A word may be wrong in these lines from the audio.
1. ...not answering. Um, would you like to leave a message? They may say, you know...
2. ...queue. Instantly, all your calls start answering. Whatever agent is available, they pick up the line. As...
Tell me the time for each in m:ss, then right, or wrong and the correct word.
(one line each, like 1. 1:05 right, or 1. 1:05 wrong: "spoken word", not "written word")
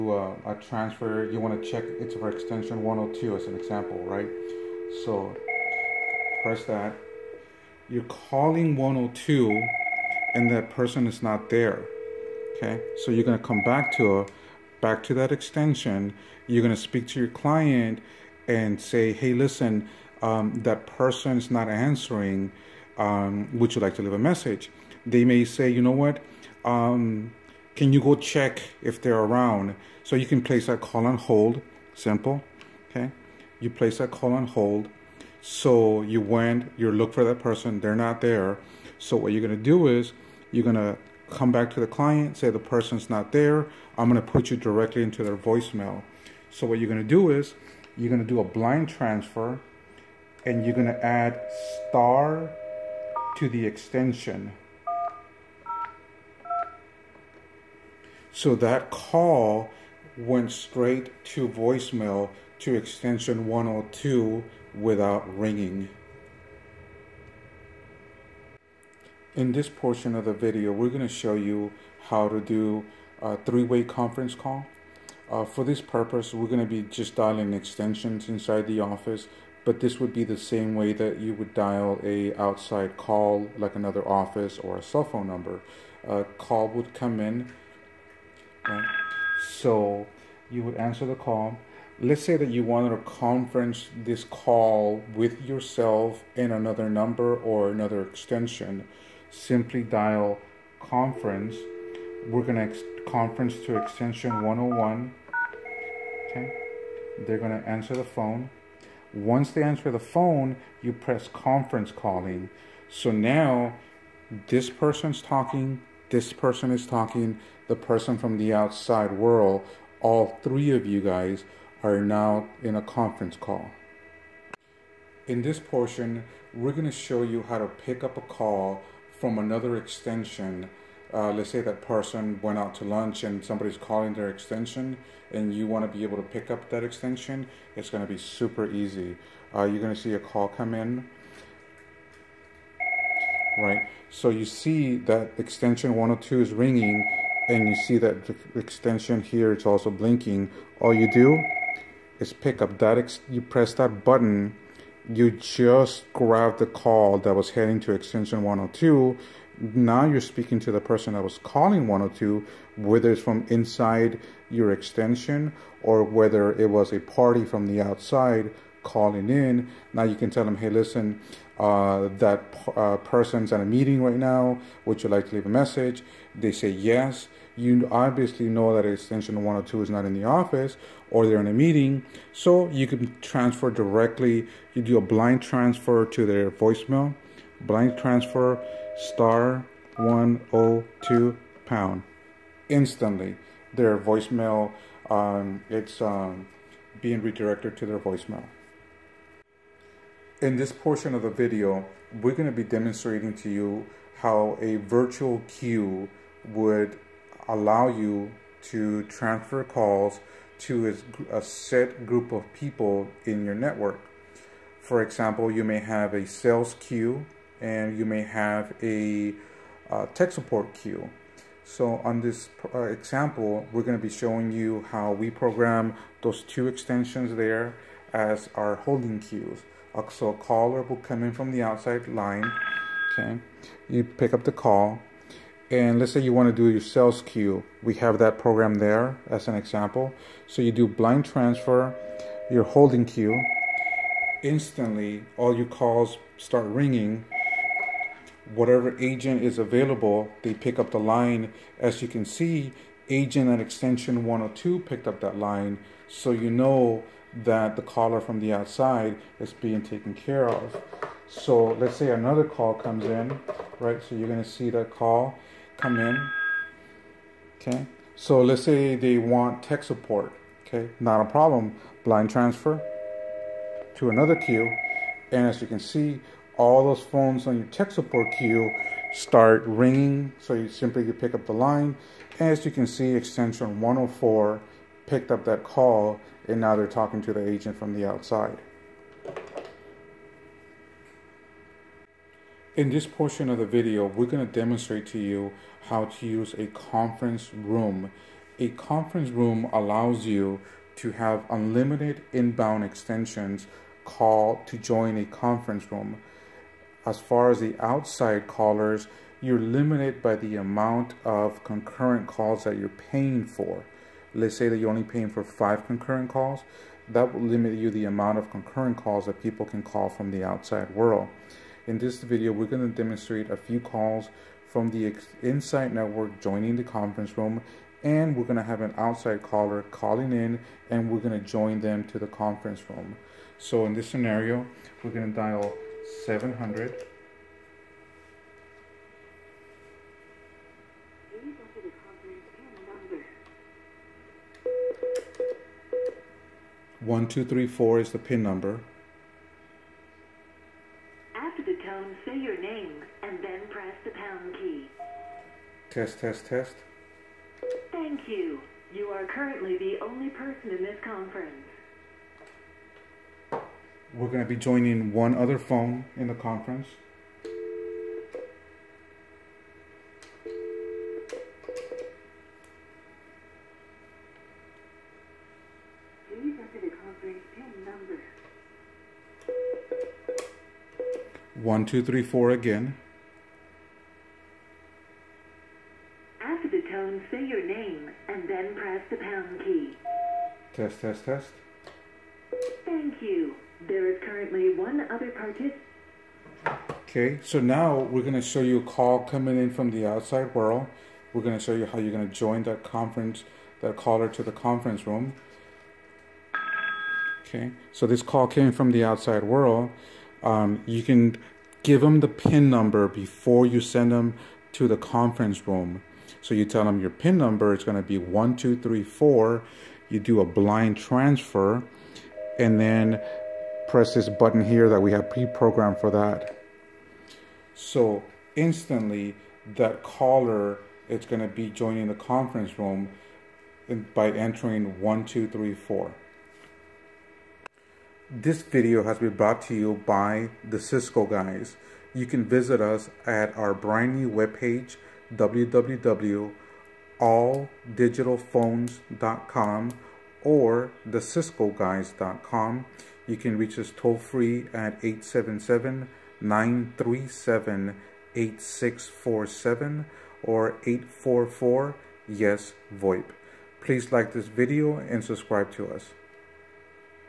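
1. 0:21 right
2. 4:03 wrong: "ringing", not "answering".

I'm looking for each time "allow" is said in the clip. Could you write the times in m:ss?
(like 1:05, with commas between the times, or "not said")
3:27, 4:59.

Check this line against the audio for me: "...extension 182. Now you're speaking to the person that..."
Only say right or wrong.
wrong.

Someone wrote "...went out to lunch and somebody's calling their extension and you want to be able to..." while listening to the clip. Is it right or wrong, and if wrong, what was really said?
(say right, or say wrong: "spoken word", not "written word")
right.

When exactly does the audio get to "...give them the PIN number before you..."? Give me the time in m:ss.
6:51.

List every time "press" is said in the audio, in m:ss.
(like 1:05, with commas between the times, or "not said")
0:06, 1:50, 2:33, 5:53, 6:28, 7:03.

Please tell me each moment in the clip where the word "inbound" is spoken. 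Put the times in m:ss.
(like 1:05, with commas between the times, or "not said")
5:02.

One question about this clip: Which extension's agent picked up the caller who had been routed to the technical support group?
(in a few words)
104.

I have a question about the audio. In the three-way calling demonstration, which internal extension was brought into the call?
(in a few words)
101.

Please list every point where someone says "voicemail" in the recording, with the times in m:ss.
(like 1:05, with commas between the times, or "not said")
0:45, 1:01, 3:06, 3:13, 3:17.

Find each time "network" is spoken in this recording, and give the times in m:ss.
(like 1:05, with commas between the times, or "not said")
3:33, 5:25.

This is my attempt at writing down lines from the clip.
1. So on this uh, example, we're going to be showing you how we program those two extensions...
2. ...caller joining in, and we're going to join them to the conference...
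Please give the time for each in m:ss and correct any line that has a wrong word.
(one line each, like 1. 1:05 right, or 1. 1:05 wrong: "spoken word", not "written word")
1. 3:41 right
2. 5:29 wrong: "calling", not "joining".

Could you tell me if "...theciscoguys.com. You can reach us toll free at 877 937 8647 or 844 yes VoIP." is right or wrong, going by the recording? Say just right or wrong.
right.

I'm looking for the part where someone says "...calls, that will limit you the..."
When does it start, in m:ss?
5:16.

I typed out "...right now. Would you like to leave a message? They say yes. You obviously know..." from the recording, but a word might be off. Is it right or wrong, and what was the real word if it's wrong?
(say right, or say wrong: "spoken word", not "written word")
right.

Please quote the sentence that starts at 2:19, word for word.
Uh, you're going to see a call come in right?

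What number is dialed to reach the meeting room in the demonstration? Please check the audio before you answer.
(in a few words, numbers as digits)
700.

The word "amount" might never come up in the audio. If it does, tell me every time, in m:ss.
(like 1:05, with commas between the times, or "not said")
5:10, 5:18.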